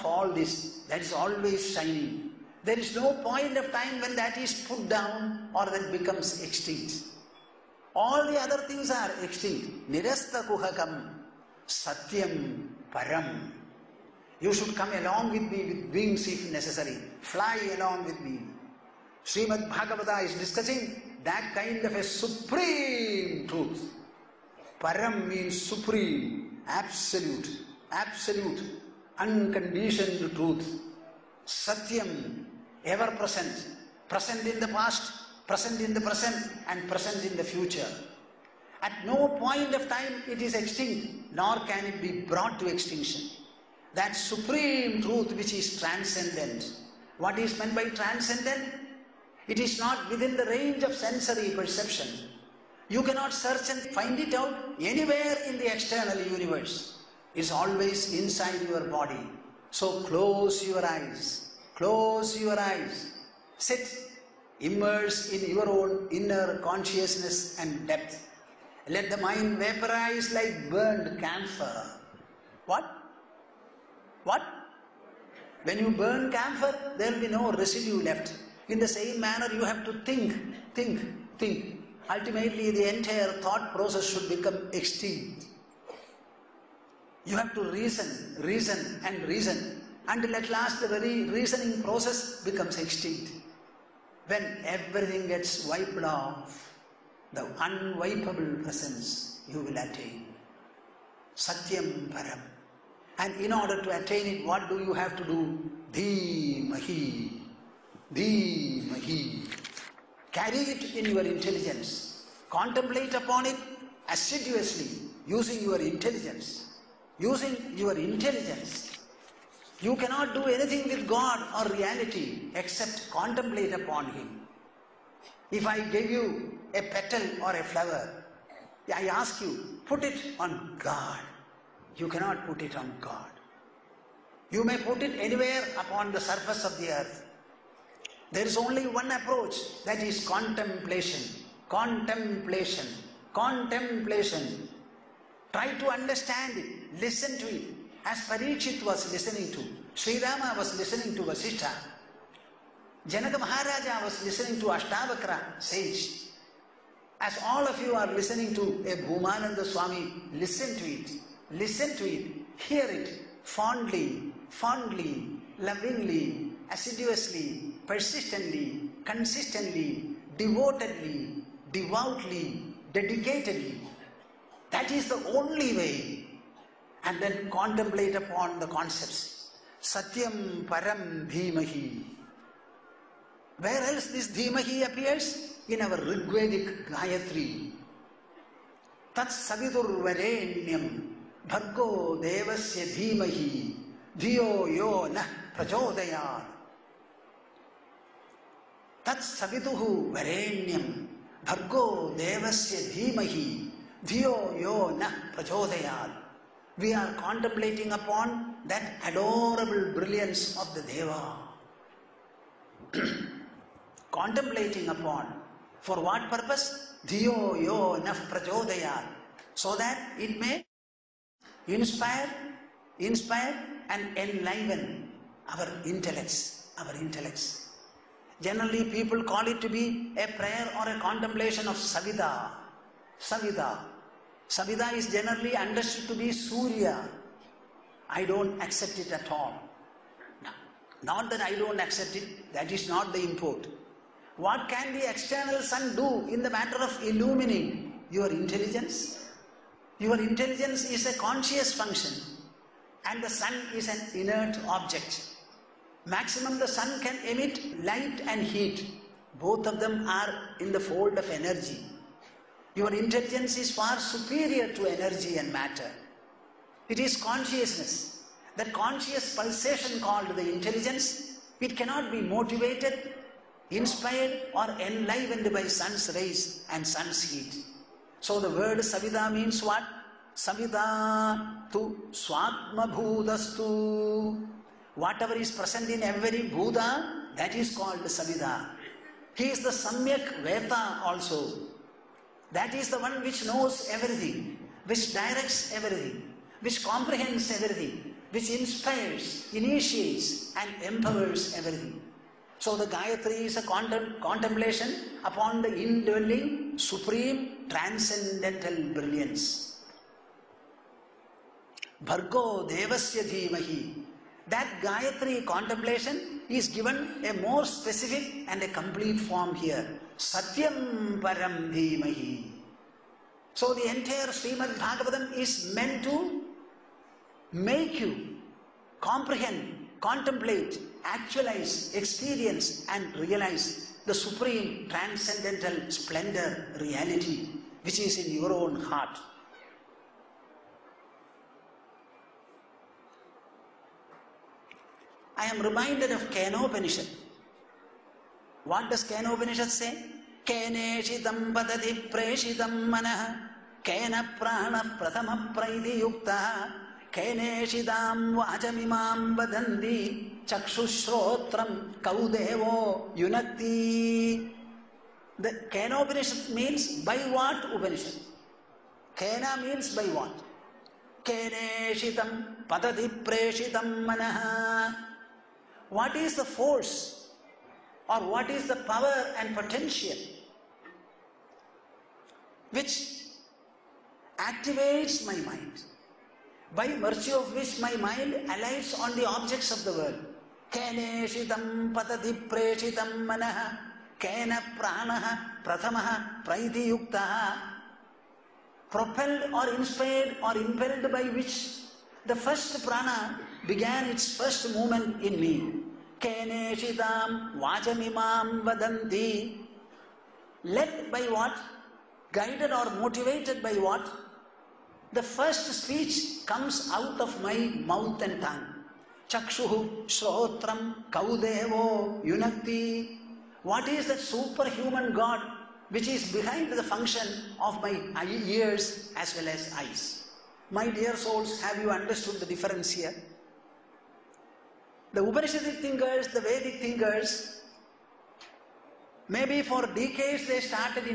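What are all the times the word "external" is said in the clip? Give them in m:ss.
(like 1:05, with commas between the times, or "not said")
0:55, 4:05.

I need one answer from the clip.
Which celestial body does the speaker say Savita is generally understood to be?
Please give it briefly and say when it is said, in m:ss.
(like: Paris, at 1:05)
Surya, at 3:56.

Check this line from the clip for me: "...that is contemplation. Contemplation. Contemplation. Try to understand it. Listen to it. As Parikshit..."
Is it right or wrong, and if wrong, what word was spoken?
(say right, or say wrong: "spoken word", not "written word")
right.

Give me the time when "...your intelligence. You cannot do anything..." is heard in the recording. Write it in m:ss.
1:57.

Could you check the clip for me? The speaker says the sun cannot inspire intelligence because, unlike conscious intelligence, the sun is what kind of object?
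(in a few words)
inert object.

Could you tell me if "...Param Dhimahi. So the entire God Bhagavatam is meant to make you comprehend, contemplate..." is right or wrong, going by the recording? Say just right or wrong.
wrong.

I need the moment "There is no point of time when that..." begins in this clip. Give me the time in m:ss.
0:02.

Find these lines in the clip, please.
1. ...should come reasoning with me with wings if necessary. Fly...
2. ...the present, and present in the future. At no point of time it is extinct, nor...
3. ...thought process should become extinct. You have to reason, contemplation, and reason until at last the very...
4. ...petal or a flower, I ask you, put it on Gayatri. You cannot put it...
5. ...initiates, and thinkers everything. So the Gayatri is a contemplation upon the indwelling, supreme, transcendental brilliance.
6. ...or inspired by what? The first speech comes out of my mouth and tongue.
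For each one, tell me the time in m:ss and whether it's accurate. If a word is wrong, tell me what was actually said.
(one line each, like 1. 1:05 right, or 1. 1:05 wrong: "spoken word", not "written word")
1. 0:14 wrong: "along", not "reasoning"
2. 0:35 right
3. 1:23 wrong: "reason", not "contemplation"
4. 2:06 wrong: "God", not "Gayatri"
5. 4:59 wrong: "empowers", not "thinkers"
6. 6:52 wrong: "motivated", not "inspired".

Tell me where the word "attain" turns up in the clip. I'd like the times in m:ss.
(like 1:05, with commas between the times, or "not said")
1:39, 1:43.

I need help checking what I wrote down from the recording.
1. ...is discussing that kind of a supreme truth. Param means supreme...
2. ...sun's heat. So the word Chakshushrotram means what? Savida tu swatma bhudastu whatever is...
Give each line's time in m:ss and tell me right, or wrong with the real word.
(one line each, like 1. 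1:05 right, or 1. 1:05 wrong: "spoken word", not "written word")
1. 0:20 right
2. 4:36 wrong: "Savida", not "Chakshushrotram".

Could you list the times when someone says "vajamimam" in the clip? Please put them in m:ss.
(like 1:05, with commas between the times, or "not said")
5:58, 6:47.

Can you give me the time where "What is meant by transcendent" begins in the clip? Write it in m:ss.
0:47.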